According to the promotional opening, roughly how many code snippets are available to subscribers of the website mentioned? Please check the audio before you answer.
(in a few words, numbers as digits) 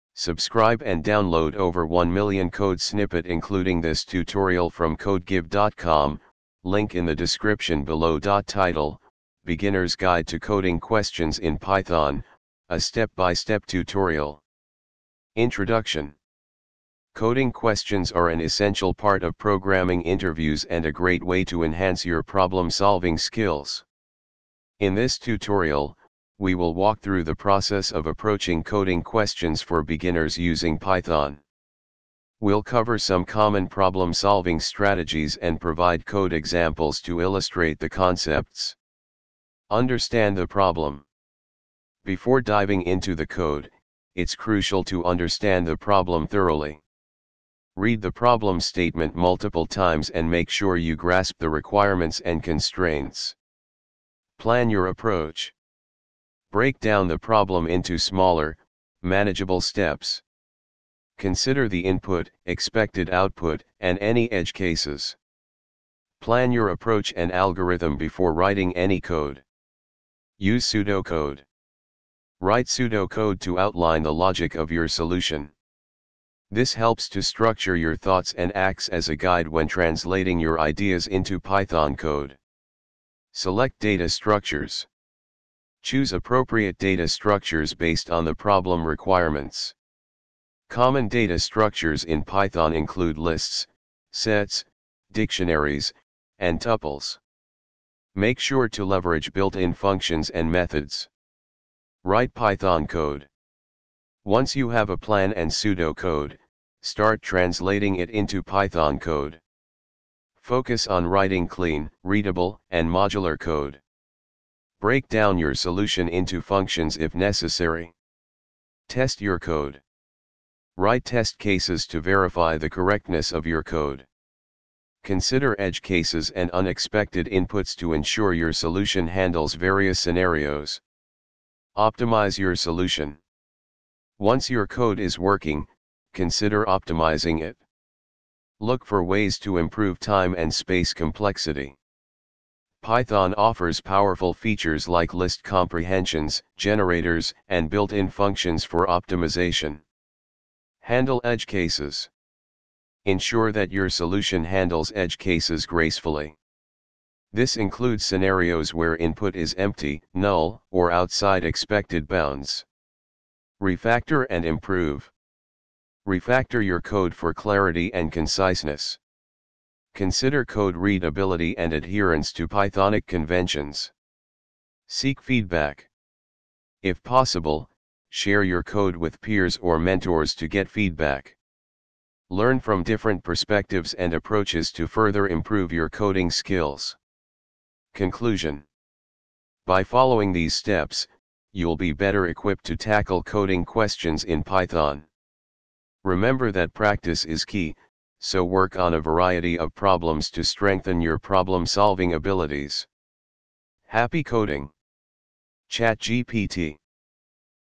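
1 million.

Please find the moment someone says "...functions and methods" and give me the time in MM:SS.
01:39.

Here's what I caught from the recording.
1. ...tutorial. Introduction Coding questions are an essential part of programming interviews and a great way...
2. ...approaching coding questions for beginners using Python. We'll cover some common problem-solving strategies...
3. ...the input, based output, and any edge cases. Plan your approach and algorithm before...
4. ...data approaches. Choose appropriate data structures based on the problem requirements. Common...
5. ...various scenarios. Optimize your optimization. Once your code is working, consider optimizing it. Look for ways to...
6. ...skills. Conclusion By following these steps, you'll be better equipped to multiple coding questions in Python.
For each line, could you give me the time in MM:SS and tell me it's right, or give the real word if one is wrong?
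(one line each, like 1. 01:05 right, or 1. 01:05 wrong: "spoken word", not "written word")
1. 00:13 right
2. 00:28 right
3. 01:01 wrong: "expected", not "based"
4. 01:23 wrong: "structures", not "approaches"
5. 02:09 wrong: "solution", not "optimization"
6. 03:06 wrong: "tackle", not "multiple".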